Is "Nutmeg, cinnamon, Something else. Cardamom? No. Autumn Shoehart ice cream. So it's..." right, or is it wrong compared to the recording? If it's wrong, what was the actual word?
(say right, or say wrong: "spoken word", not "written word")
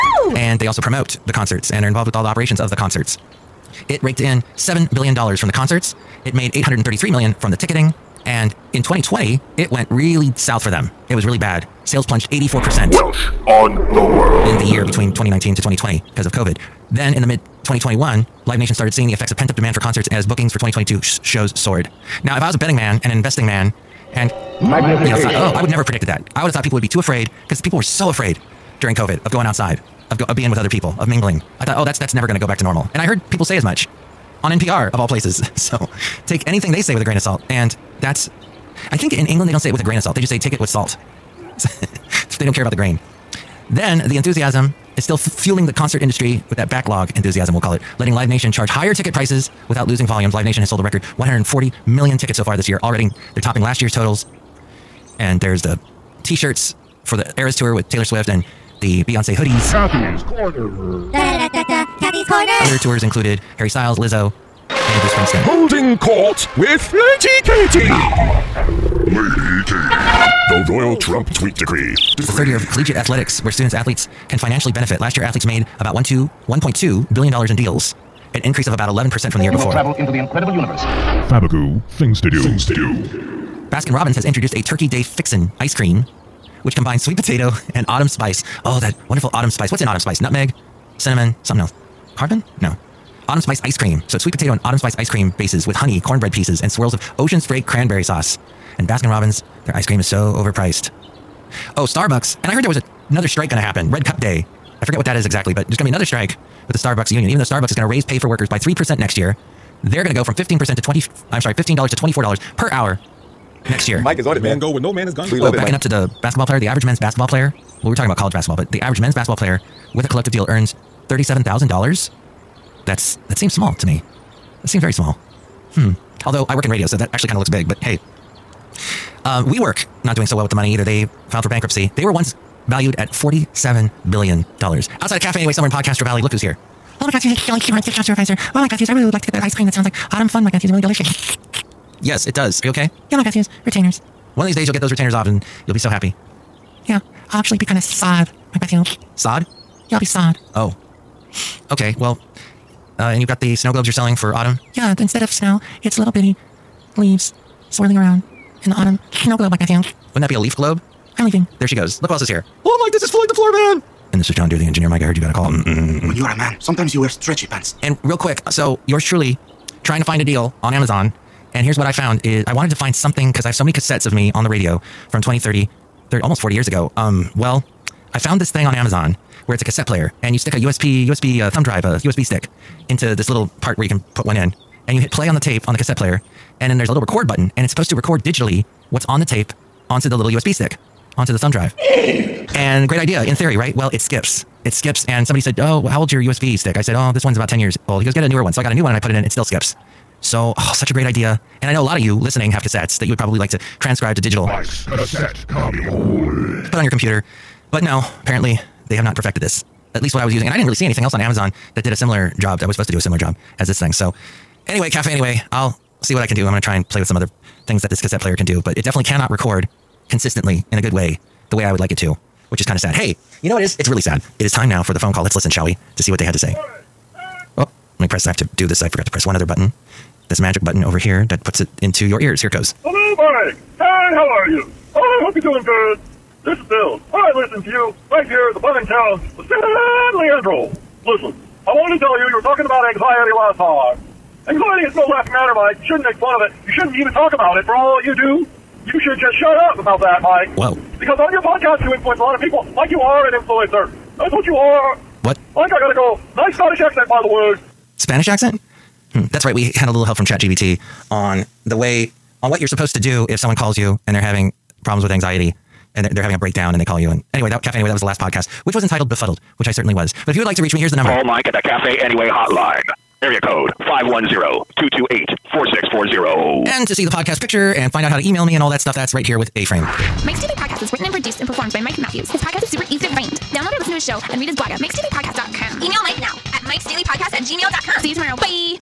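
wrong: "Spice", not "Shoehart".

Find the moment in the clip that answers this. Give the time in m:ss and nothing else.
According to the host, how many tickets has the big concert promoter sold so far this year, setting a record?
0:51.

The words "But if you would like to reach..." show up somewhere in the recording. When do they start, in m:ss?
4:30.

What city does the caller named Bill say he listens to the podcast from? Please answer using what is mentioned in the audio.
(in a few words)
San Leandro.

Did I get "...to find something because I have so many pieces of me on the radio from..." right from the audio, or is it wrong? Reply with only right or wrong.
wrong.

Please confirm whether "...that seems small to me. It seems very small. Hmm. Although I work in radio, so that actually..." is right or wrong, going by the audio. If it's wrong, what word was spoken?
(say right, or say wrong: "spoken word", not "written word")
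right.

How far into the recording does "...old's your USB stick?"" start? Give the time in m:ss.
3:16.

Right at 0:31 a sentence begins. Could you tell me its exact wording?
I thought, oh, that's that's never going to go back to normal.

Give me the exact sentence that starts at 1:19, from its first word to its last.
Will travel into the incredible universe.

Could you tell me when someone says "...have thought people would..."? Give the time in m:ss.
0:26.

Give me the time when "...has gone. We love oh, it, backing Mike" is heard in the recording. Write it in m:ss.
1:55.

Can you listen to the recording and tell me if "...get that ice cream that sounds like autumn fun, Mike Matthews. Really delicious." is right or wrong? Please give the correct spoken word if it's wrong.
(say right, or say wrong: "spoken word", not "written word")
right.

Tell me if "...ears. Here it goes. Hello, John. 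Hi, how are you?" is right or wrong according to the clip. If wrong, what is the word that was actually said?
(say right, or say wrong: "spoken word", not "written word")
wrong: "Mike", not "John".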